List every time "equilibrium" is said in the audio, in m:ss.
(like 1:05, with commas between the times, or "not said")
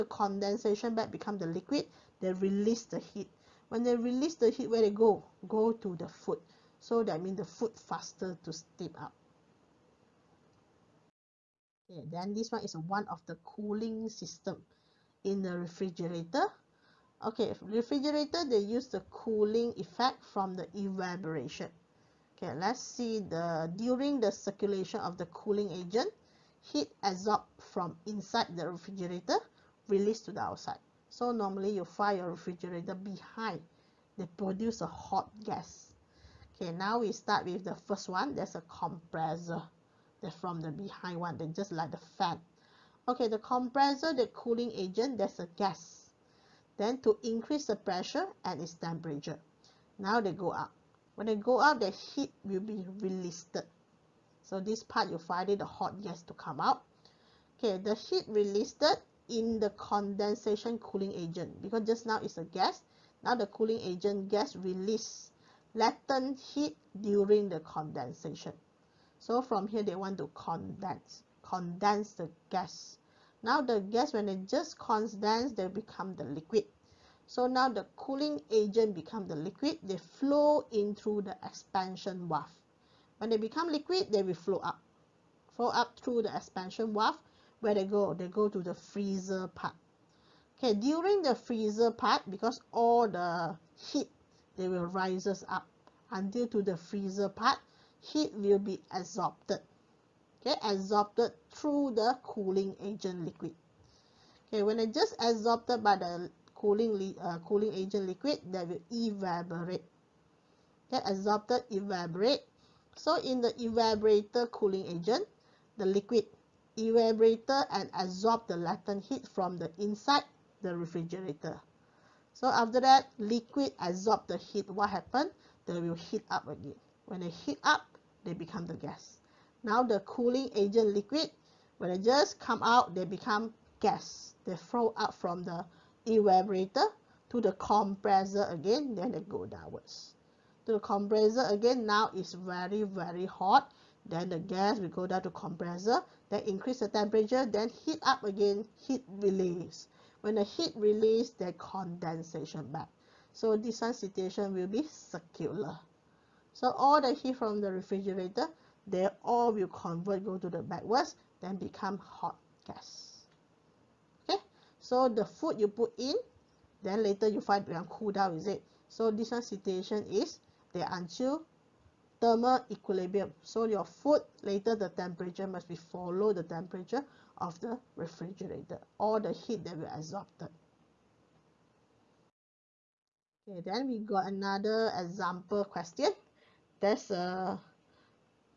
2:52.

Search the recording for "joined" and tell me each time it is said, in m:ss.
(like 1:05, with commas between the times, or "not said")
not said.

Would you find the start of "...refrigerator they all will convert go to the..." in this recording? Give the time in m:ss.
2:37.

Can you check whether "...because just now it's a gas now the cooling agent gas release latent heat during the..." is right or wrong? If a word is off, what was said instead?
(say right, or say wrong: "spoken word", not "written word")
right.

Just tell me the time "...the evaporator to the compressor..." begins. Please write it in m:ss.
2:15.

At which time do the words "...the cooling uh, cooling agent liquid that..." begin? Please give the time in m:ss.
1:45.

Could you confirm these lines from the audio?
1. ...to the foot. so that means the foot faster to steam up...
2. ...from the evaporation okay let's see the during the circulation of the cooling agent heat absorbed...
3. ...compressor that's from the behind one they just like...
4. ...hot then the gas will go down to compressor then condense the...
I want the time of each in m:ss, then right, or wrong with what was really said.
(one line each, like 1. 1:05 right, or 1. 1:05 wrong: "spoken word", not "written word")
1. 0:05 right
2. 0:20 right
3. 0:38 right
4. 2:23 wrong: "increase", not "condense".